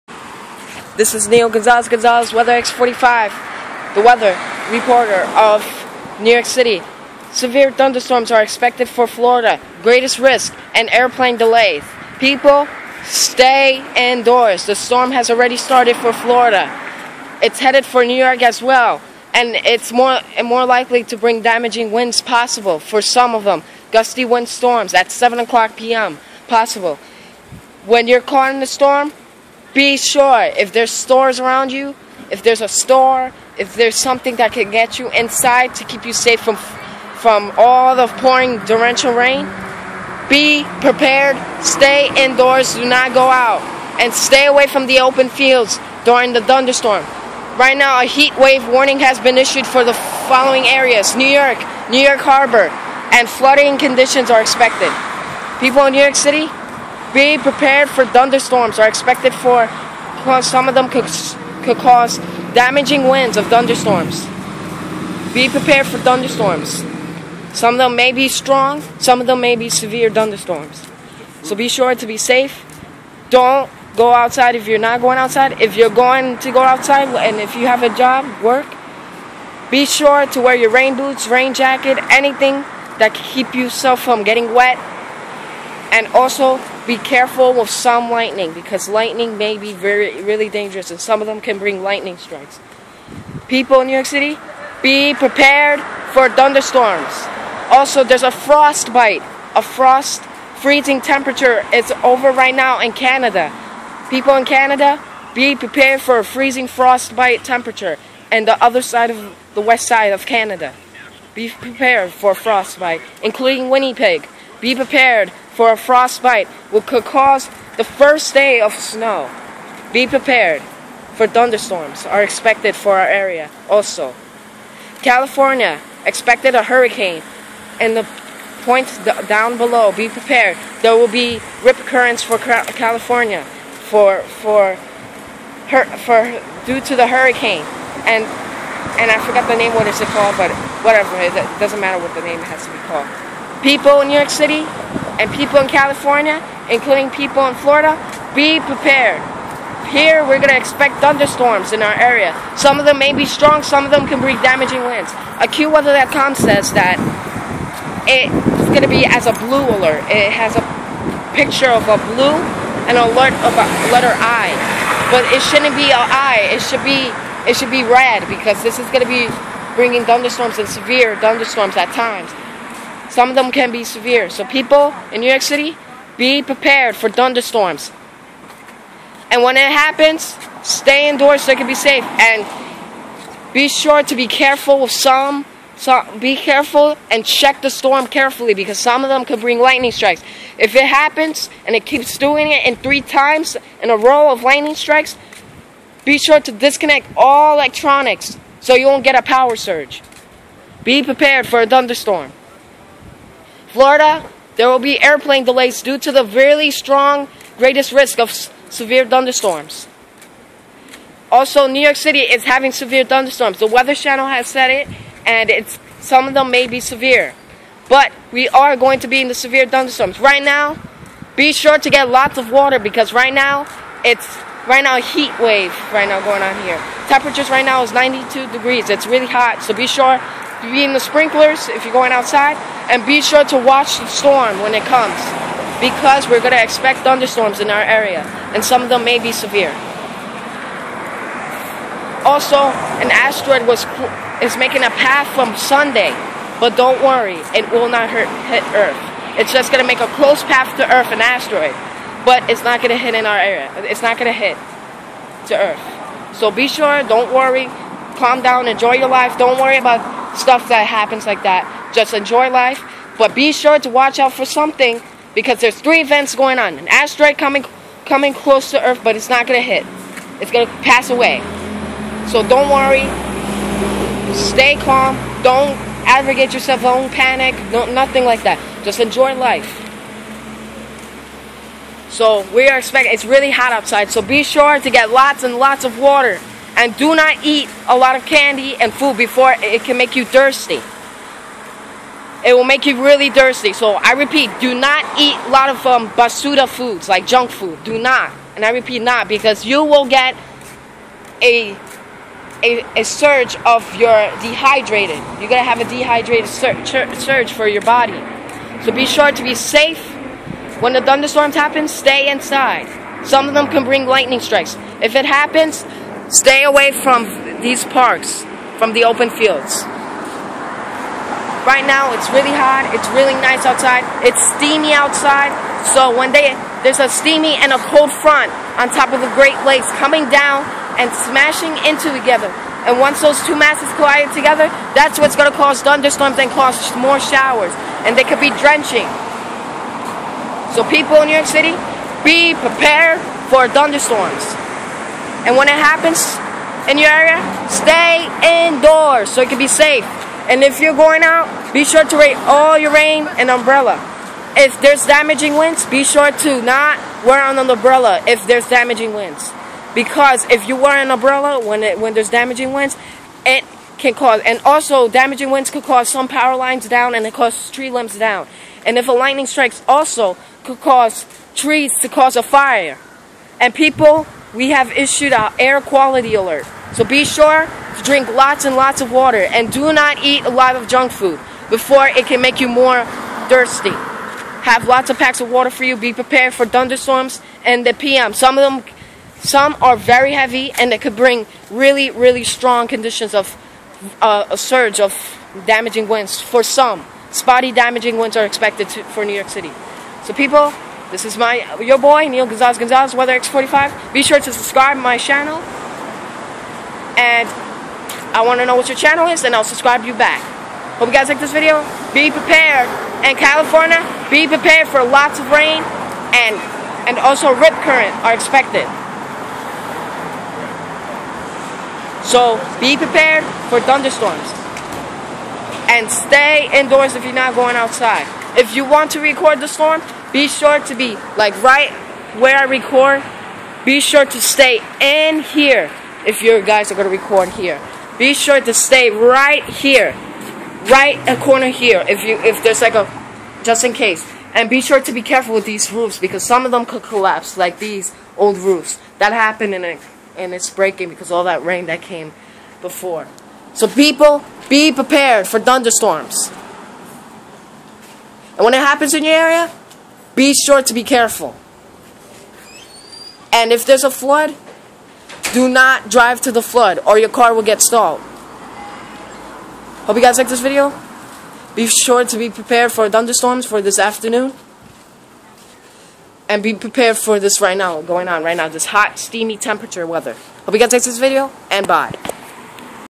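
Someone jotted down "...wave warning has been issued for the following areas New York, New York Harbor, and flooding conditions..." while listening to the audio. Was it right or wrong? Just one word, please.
right.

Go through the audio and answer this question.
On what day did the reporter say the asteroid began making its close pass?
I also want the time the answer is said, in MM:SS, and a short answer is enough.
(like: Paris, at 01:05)
Sunday, at 04:05.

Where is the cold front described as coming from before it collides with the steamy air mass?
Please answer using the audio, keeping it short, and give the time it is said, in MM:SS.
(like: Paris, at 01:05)
The Great Lakes, at 05:29.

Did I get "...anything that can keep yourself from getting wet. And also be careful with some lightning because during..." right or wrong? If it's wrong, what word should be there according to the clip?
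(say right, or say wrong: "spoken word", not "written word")
wrong: "lightning", not "during".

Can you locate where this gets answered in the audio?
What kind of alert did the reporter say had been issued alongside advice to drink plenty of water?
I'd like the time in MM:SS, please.
06:15.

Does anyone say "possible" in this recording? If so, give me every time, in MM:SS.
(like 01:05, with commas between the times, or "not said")
00:22, 00:26.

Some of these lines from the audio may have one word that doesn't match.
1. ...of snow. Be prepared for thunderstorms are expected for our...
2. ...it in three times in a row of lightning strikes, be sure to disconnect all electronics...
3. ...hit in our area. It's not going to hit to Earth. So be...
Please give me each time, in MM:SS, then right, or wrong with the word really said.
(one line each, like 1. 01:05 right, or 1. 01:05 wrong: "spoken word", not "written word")
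1. 01:58 right
2. 03:12 right
3. 04:12 right.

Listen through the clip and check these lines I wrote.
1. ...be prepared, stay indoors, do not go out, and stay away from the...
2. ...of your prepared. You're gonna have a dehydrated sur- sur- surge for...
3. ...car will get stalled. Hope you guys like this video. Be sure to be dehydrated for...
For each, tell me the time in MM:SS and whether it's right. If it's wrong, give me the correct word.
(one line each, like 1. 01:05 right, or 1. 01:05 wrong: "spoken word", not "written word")
1. 00:40 right
2. 05:03 wrong: "dehydrated", not "prepared"
3. 07:47 wrong: "prepared", not "dehydrated".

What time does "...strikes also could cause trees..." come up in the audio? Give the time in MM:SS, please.
06:09.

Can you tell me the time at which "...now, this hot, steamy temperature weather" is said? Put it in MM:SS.
07:58.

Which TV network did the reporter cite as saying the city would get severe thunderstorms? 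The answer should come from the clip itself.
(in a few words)
The Weather Channel.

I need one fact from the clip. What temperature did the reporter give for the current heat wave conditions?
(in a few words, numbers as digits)
92 degrees.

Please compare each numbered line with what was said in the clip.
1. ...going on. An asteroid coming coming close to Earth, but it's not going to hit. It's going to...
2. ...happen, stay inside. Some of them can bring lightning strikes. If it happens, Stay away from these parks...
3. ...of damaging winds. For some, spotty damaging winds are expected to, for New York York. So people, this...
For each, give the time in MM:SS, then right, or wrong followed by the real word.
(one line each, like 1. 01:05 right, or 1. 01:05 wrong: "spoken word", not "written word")
1. 04:26 right
2. 05:11 right
3. 06:34 wrong: "City", not "York".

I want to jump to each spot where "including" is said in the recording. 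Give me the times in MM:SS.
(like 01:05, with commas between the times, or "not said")
01:53, 02:26.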